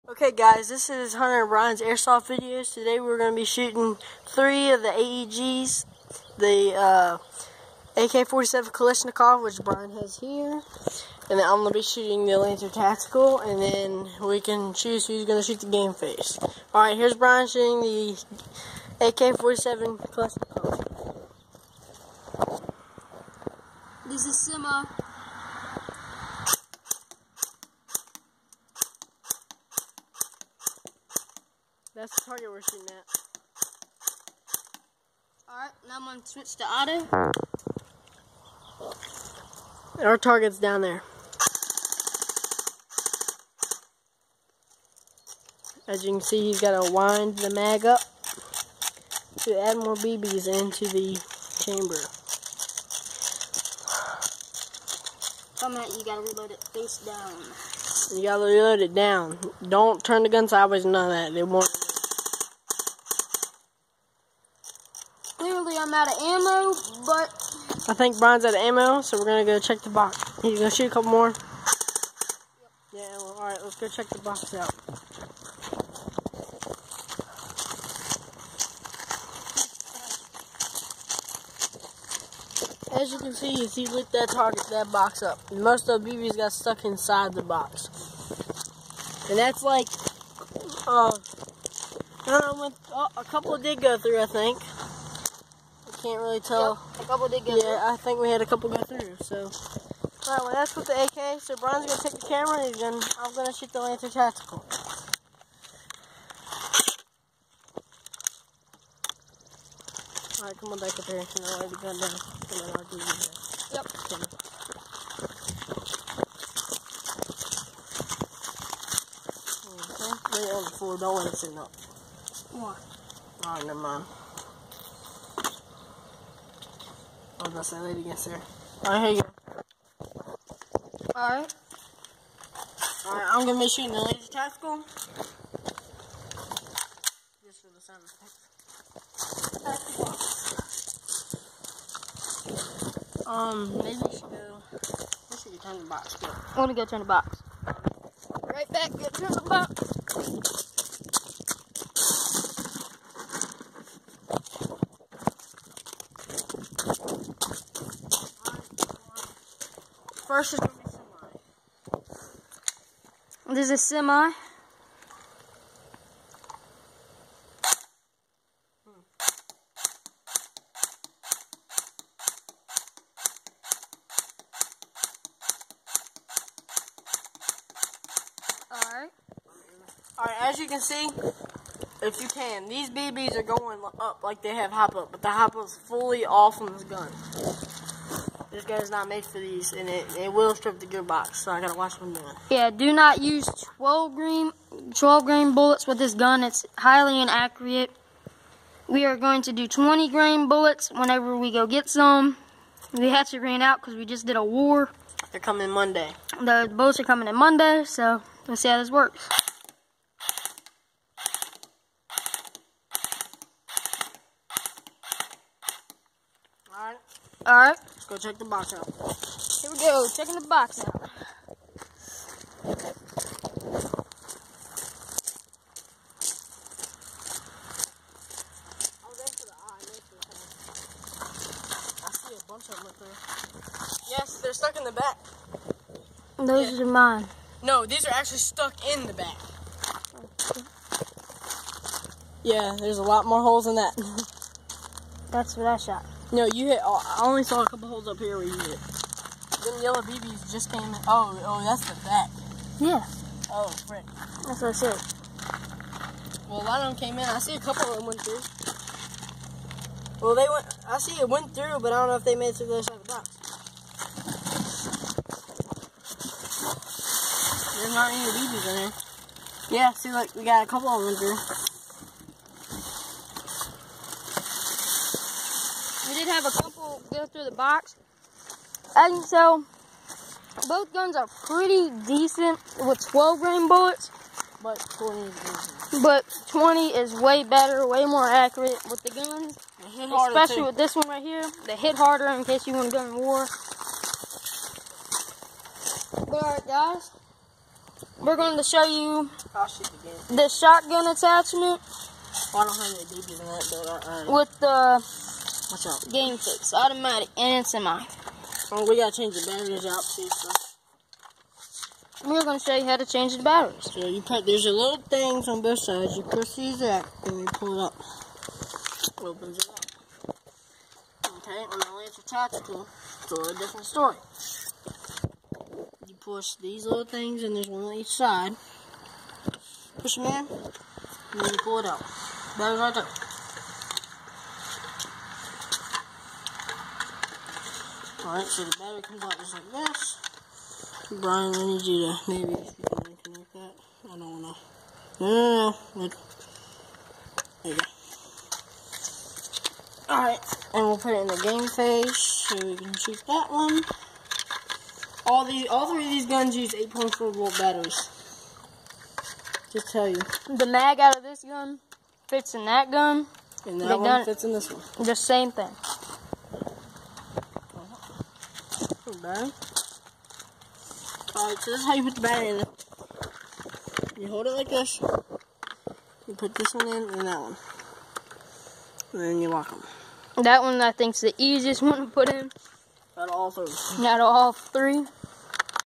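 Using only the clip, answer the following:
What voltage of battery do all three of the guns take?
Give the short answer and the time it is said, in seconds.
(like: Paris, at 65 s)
8.4 volt, at 356 s.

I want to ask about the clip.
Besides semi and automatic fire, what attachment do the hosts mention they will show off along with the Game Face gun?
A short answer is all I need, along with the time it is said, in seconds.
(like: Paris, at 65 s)
shotgun attachment, at 300 s.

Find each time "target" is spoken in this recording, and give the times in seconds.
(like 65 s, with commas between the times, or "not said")
32 s, 40 s, 84 s.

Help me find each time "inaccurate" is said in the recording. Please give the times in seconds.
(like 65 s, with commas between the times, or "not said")
197 s.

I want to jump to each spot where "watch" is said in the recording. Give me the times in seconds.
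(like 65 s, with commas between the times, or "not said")
191 s, 305 s.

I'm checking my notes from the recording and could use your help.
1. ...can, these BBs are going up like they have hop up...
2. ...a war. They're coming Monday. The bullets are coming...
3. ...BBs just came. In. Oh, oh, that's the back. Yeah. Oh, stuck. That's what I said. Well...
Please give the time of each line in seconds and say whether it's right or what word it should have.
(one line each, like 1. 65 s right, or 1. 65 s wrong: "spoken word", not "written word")
1. 182 s right
2. 204 s right
3. 250 s wrong: "frick", not "stuck".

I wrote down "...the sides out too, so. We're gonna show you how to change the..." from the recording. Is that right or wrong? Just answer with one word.
wrong.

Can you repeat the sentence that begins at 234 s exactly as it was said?
Yes, they're stuck in the back.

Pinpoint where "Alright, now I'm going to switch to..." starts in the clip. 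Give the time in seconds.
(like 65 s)
35 s.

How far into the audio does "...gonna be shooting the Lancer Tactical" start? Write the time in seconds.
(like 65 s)
133 s.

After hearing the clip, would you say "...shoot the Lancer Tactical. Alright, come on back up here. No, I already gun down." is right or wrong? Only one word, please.
right.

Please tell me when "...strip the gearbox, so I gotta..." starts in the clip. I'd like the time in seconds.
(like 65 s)
190 s.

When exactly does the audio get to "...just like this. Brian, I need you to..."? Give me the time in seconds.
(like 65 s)
339 s.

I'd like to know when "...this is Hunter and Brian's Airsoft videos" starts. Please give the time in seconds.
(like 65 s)
0 s.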